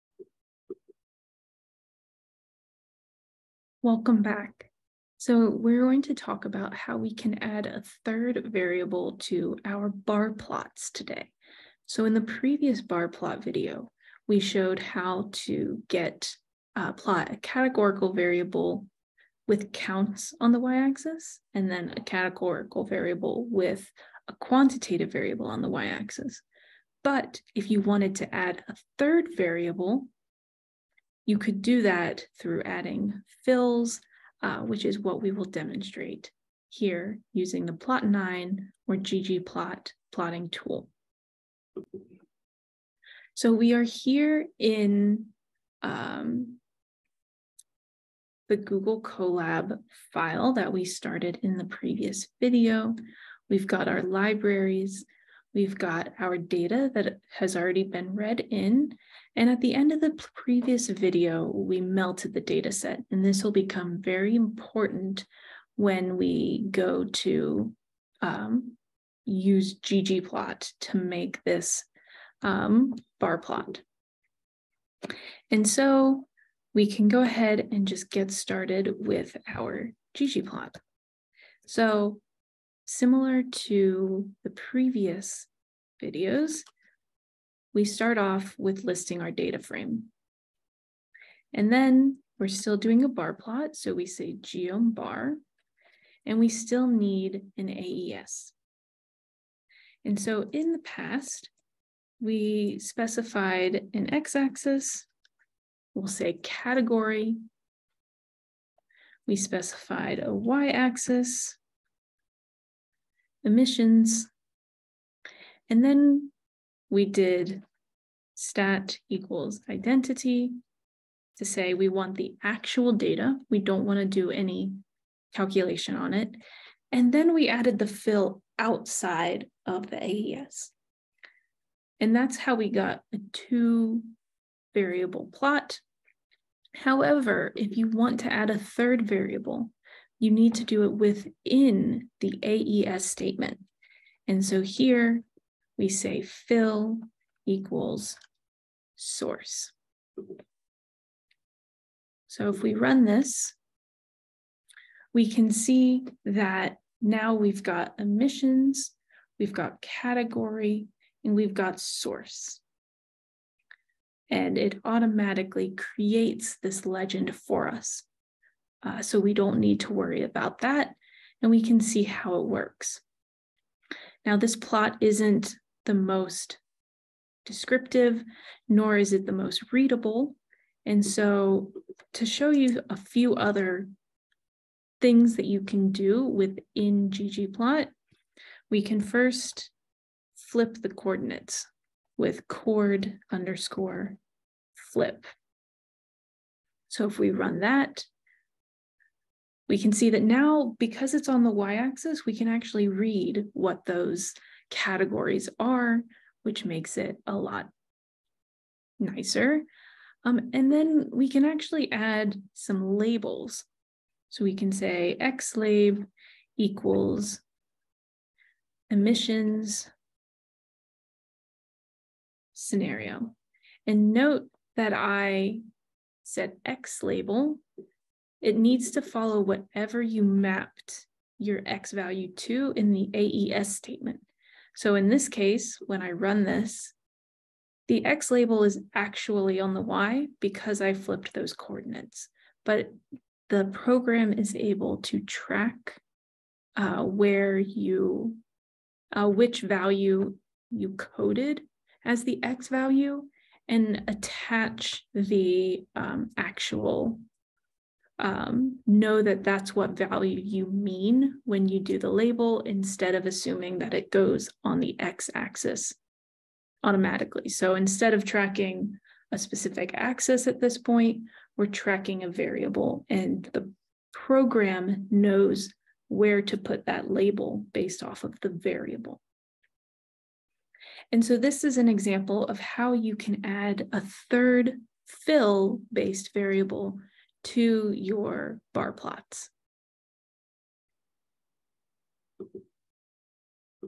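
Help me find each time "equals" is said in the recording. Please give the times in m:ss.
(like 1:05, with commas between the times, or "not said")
1:59, 2:27, 3:36.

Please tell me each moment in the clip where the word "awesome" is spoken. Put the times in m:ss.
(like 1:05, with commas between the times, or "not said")
not said.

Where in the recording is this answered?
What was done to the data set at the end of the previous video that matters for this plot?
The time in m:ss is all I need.
1:01.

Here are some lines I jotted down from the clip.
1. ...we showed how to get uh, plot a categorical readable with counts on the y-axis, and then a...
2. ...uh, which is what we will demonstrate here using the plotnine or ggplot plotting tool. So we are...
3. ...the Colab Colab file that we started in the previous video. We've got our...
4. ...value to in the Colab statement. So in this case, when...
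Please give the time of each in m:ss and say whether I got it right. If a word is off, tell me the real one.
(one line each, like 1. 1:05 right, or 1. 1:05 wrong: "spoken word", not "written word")
1. 0:14 wrong: "variable", not "readable"
2. 0:34 right
3. 0:48 wrong: "Google", not "Colab"
4. 3:51 wrong: "AES", not "Colab".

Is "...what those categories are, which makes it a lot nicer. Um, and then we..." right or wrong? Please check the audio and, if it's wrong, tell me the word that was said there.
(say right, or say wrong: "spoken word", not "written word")
right.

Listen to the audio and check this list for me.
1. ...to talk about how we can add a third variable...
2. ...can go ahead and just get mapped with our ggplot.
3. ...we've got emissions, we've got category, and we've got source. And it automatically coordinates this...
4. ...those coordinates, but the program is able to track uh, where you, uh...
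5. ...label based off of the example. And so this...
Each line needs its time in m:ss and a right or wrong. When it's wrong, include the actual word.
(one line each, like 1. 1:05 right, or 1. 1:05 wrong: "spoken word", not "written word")
1. 0:06 right
2. 1:16 wrong: "started", not "mapped"
3. 2:37 wrong: "creates", not "coordinates"
4. 4:01 right
5. 4:37 wrong: "variable", not "example".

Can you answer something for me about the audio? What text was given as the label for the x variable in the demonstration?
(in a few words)
Emissions scenario.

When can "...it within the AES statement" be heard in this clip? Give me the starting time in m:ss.
2:20.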